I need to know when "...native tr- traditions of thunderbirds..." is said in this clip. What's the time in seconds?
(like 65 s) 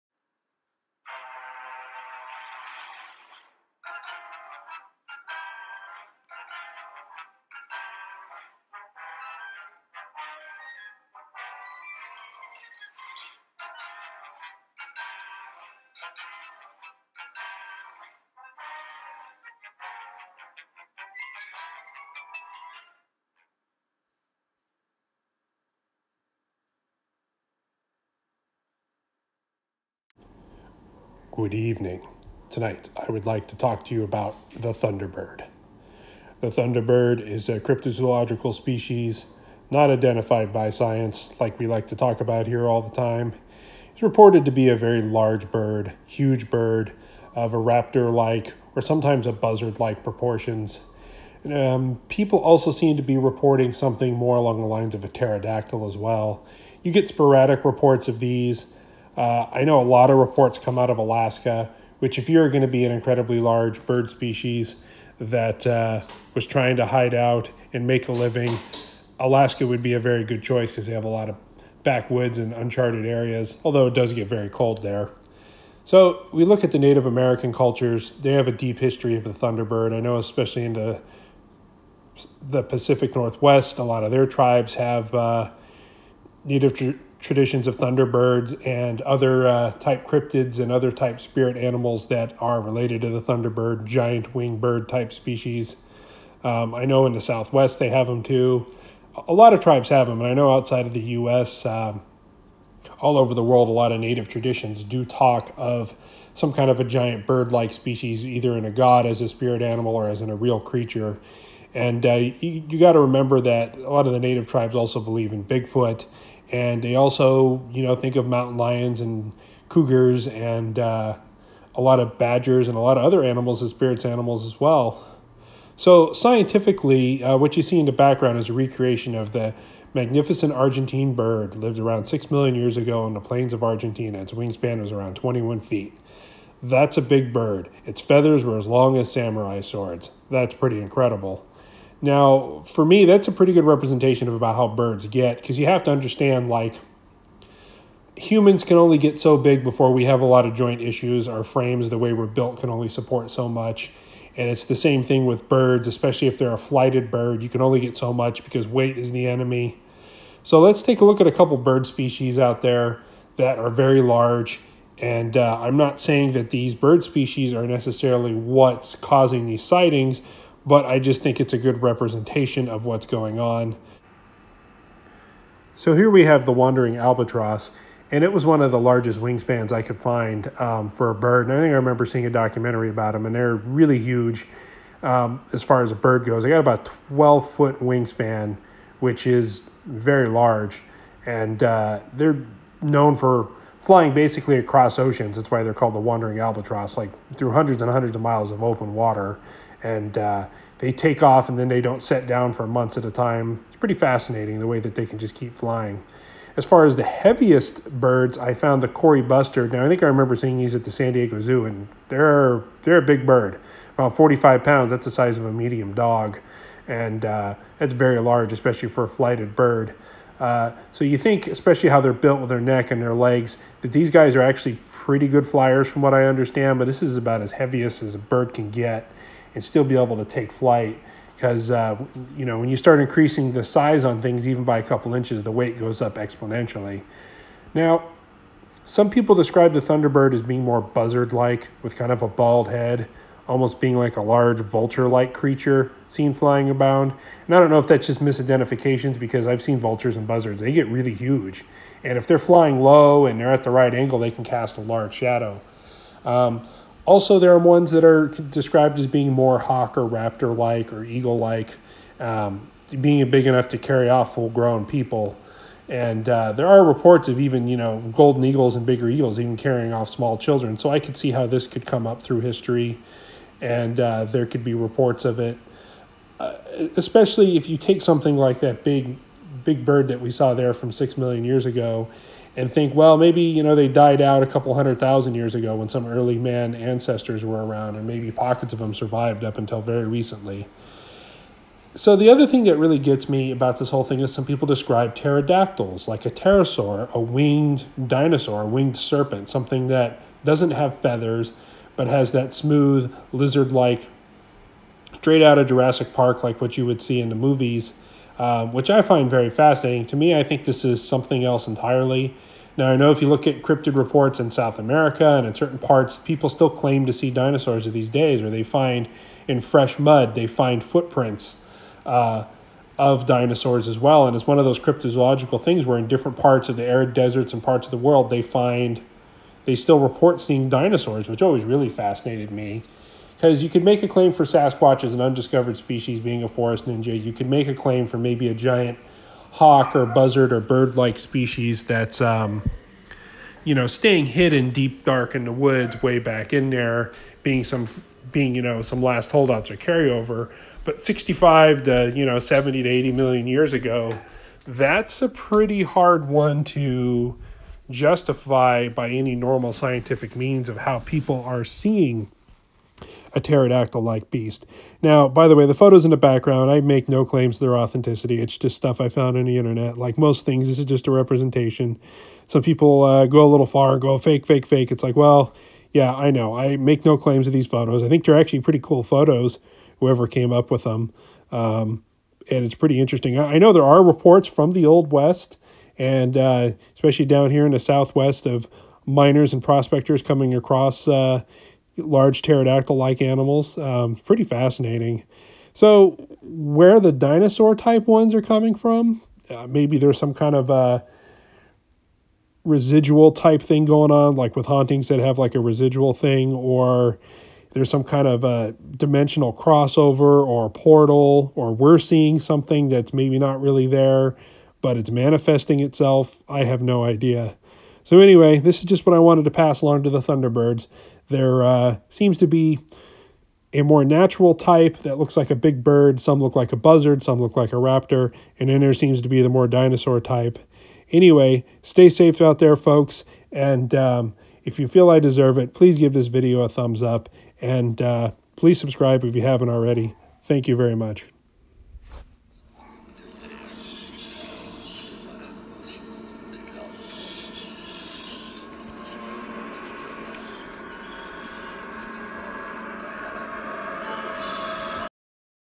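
86 s.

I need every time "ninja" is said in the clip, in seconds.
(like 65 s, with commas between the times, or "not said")
336 s.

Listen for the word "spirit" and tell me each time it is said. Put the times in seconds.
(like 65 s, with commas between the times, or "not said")
91 s, 109 s, 123 s.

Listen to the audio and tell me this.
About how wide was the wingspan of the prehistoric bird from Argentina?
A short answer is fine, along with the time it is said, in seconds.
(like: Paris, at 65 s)
21 feet, at 135 s.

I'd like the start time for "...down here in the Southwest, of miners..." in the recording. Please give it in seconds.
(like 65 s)
387 s.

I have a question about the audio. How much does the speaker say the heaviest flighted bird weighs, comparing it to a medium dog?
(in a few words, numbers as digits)
45 pounds.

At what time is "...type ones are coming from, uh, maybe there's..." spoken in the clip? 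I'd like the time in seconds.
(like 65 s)
397 s.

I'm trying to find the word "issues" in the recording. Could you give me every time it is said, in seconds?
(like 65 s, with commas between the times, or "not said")
150 s.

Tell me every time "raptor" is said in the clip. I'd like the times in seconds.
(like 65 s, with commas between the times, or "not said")
47 s, 260 s, 427 s.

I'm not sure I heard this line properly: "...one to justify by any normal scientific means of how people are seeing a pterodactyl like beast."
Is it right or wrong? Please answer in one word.
right.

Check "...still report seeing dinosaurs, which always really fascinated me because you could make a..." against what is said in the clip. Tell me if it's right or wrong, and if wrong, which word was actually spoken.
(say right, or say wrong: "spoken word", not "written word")
right.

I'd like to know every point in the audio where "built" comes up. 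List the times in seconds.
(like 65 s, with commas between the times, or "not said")
152 s, 222 s.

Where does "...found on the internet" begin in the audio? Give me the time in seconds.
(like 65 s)
369 s.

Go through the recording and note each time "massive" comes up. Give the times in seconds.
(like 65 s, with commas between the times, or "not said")
not said.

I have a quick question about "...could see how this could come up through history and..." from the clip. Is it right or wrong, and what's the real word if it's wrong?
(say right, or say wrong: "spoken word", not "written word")
right.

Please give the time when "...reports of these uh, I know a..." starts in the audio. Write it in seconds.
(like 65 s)
57 s.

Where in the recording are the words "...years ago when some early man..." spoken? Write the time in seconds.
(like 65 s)
285 s.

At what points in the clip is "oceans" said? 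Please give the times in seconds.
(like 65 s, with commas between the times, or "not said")
194 s.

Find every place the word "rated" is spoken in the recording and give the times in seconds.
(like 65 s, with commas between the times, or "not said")
not said.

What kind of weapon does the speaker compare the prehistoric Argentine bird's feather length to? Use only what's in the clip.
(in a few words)
samurai swords.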